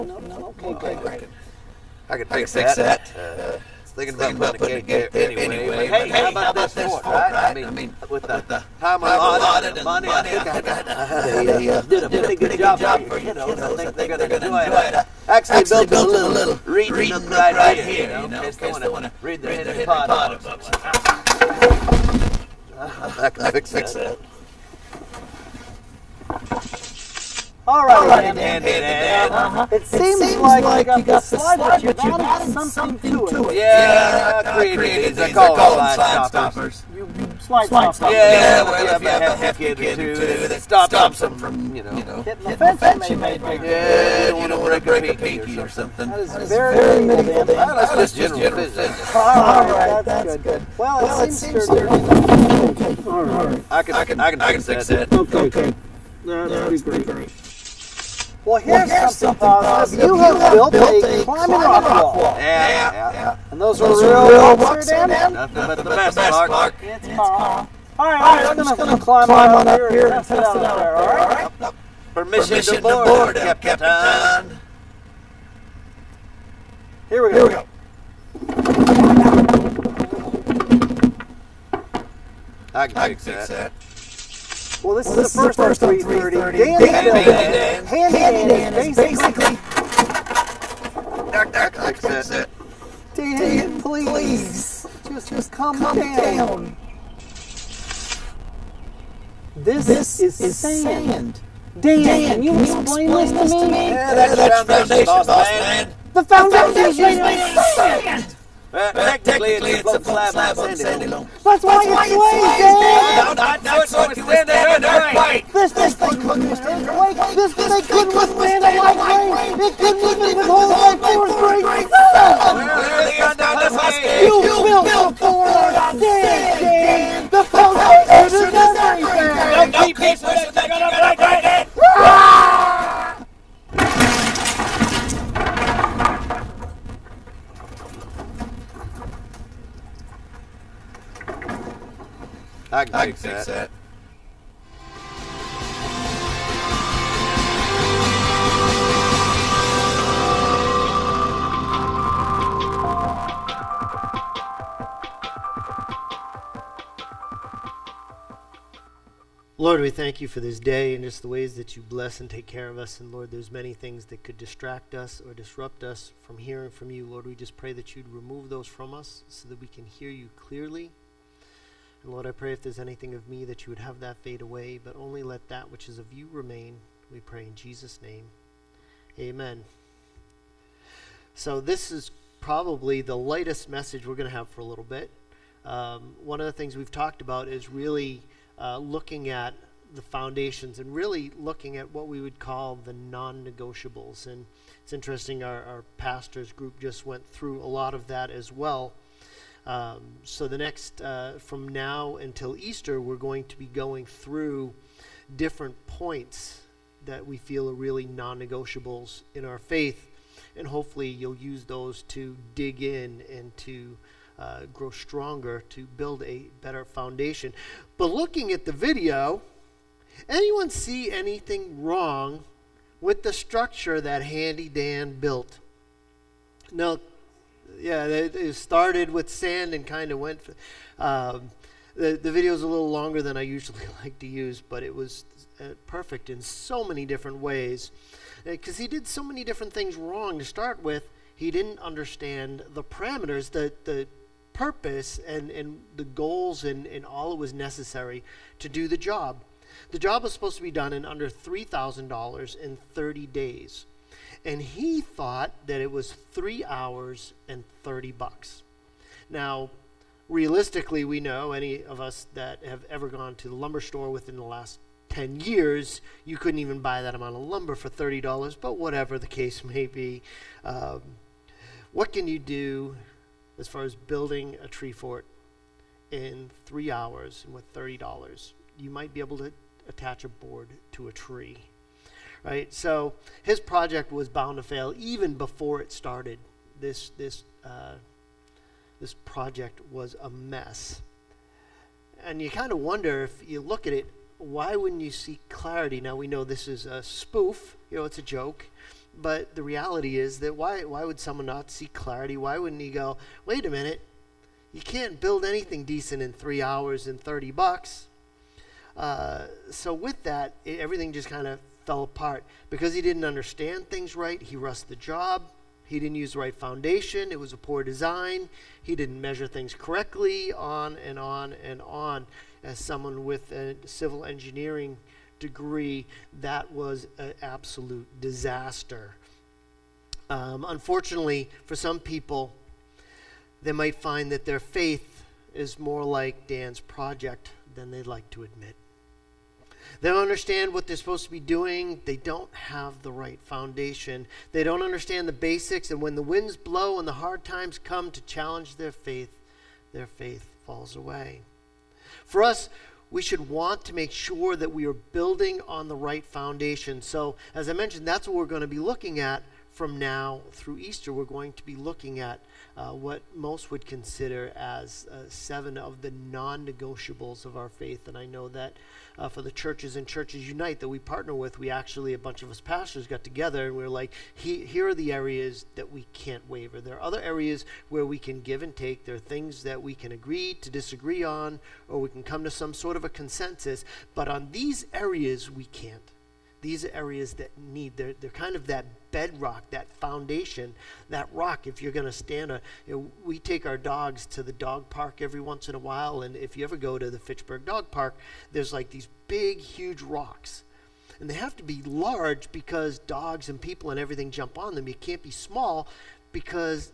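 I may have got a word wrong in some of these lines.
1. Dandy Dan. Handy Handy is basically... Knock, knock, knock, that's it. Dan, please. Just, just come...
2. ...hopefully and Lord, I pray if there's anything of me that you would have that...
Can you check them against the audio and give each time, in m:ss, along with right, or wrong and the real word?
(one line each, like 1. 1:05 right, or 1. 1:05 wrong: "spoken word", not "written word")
1. 1:26 wrong: "Dan", not "Handy"
2. 2:50 wrong: "clearly", not "hopefully".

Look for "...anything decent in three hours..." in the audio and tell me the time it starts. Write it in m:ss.
5:05.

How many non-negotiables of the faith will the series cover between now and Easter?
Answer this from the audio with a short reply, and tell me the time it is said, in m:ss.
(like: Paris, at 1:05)
7, at 6:05.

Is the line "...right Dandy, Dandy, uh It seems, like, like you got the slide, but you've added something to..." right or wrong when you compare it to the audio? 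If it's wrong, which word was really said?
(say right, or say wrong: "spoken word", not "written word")
right.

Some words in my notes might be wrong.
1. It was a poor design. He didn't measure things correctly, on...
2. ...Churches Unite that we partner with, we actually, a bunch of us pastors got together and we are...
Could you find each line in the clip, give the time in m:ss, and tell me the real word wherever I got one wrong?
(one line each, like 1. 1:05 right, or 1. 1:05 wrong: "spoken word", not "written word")
1. 5:17 right
2. 6:10 right.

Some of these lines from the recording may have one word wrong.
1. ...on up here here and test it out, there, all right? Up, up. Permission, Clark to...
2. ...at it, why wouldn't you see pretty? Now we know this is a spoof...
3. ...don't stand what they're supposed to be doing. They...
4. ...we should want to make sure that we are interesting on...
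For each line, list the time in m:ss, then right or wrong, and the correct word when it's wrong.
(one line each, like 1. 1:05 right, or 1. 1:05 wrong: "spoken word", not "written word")
1. 1:09 wrong: "Permission", not "Clark"
2. 4:53 wrong: "clarity", not "pretty"
3. 5:40 wrong: "understand", not "stand"
4. 5:53 wrong: "building", not "interesting".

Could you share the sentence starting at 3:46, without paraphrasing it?
No, yeah, it, it started with sand and kind of went.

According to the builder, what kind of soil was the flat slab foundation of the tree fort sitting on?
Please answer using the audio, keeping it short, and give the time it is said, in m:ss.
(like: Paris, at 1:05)
Sandy Loam, at 1:50.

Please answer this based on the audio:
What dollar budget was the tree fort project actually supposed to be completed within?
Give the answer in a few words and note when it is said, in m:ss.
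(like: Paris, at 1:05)
$3,000, at 4:11.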